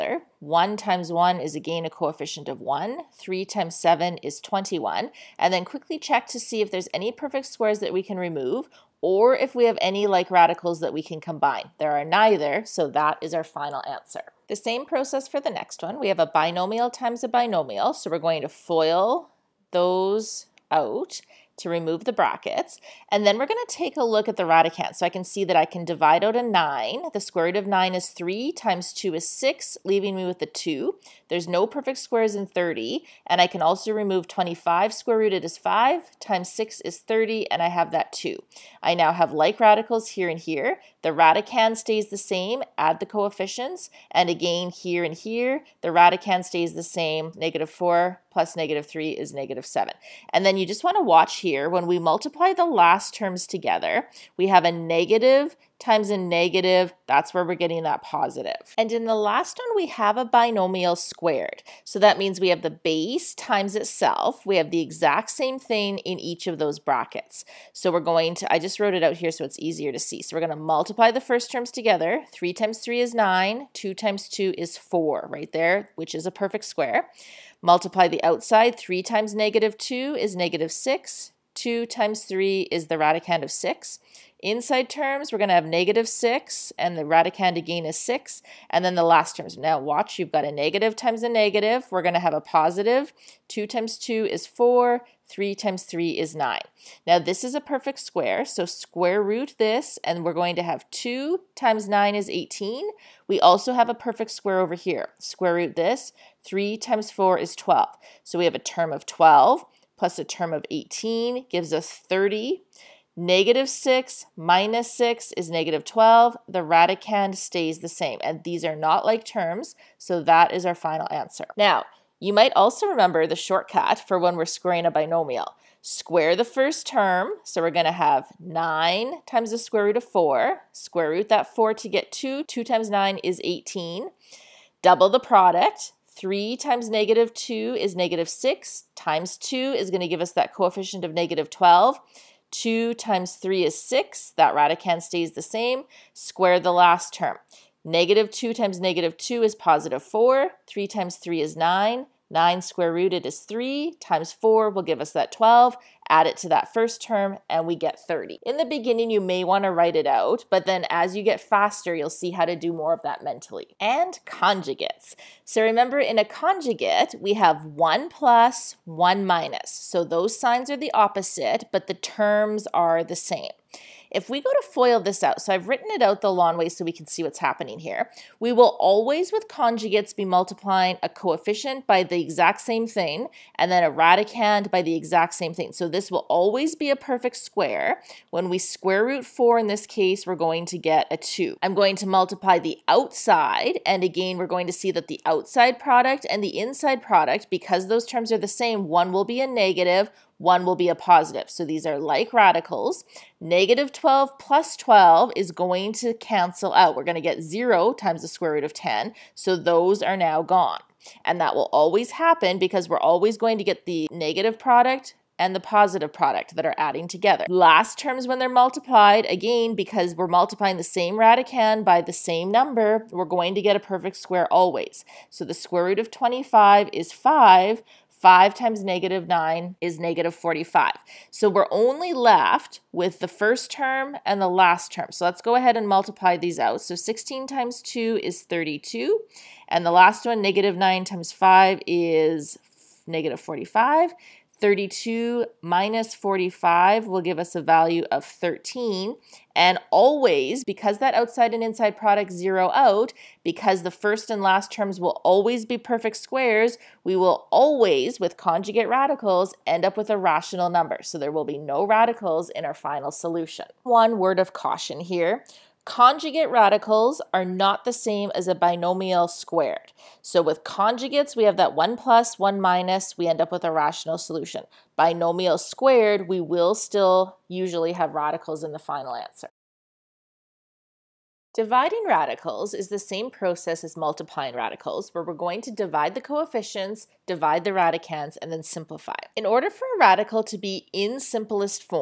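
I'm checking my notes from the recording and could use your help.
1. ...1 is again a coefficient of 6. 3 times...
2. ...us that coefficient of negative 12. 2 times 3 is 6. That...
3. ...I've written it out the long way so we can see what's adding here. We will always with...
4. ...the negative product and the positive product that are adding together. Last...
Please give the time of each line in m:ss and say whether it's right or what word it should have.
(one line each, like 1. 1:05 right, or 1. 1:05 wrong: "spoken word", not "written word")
1. 0:01 wrong: "1", not "6"
2. 2:20 right
3. 2:55 wrong: "happening", not "adding"
4. 3:33 right.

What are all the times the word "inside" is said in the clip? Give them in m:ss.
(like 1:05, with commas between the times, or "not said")
1:24, 3:16, 4:11.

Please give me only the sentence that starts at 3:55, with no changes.
So let's go ahead and multiply these out.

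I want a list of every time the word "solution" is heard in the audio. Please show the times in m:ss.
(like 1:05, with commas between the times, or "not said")
4:23, 4:34.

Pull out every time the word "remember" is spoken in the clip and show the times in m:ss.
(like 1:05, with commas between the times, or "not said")
2:02, 2:45.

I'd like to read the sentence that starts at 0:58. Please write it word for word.
And in the last one, we have a binomial squared.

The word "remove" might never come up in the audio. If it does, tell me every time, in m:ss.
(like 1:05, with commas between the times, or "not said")
0:08, 0:21, 0:33.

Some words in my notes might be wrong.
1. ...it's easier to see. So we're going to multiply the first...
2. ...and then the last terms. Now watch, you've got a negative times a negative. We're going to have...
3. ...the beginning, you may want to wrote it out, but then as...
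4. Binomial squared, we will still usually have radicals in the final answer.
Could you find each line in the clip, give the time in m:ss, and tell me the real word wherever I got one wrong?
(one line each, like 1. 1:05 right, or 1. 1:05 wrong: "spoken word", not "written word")
1. 1:09 right
2. 1:28 right
3. 2:38 wrong: "write", not "wrote"
4. 4:34 right.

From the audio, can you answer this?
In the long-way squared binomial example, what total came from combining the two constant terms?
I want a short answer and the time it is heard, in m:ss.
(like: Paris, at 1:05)
30, at 1:51.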